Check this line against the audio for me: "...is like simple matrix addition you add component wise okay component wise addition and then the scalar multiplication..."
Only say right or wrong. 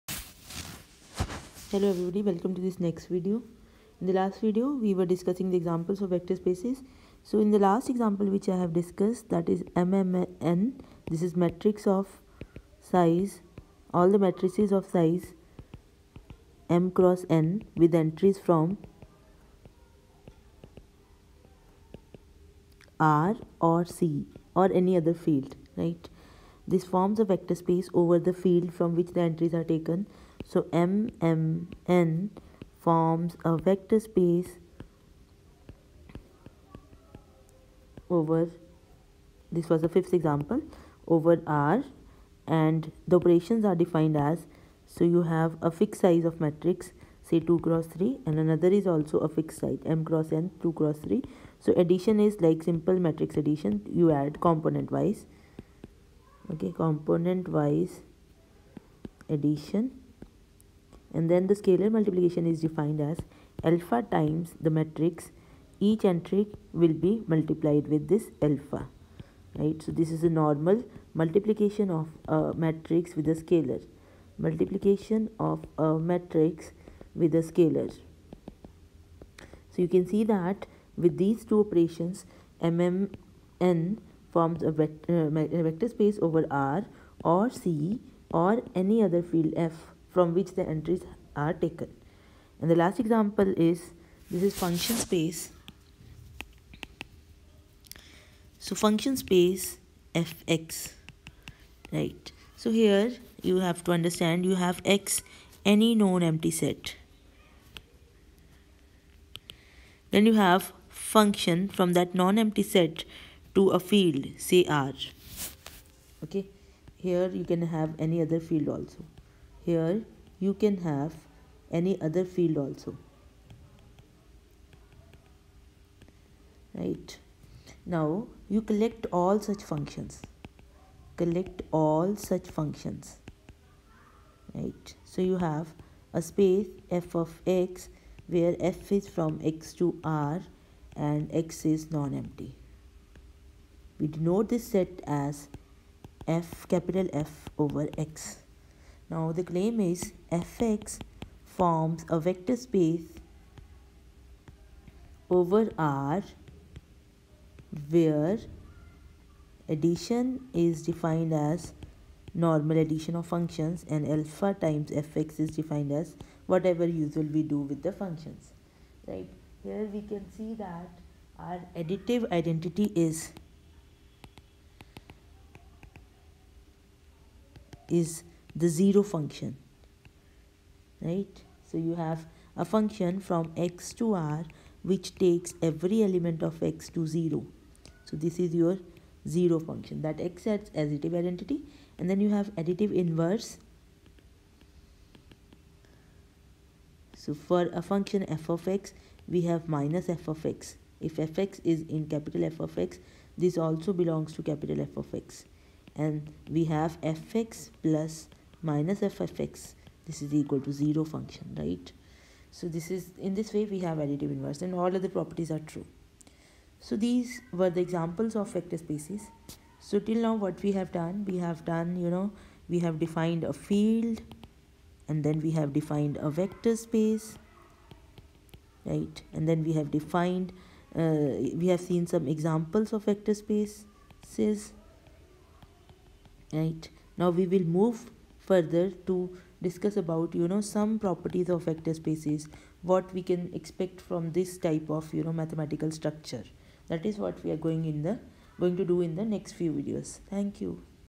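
right.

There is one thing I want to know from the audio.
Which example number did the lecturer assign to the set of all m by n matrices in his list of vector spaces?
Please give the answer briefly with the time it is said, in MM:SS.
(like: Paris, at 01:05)
Fifth, at 00:39.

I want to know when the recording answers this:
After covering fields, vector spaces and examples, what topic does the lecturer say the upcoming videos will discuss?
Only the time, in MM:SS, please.
04:01.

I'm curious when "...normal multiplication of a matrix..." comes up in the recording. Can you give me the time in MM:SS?
01:10.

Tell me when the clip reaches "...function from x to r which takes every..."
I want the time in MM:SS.
03:02.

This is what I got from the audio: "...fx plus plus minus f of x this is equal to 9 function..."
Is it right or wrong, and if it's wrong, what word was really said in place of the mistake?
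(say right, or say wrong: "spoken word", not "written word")
wrong: "0", not "9".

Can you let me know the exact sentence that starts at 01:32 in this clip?
And the last example is this is function space.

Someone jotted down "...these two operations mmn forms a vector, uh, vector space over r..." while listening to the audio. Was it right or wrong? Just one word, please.
right.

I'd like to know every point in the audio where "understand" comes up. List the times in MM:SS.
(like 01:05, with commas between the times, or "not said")
01:43.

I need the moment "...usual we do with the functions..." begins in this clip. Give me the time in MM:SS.
02:47.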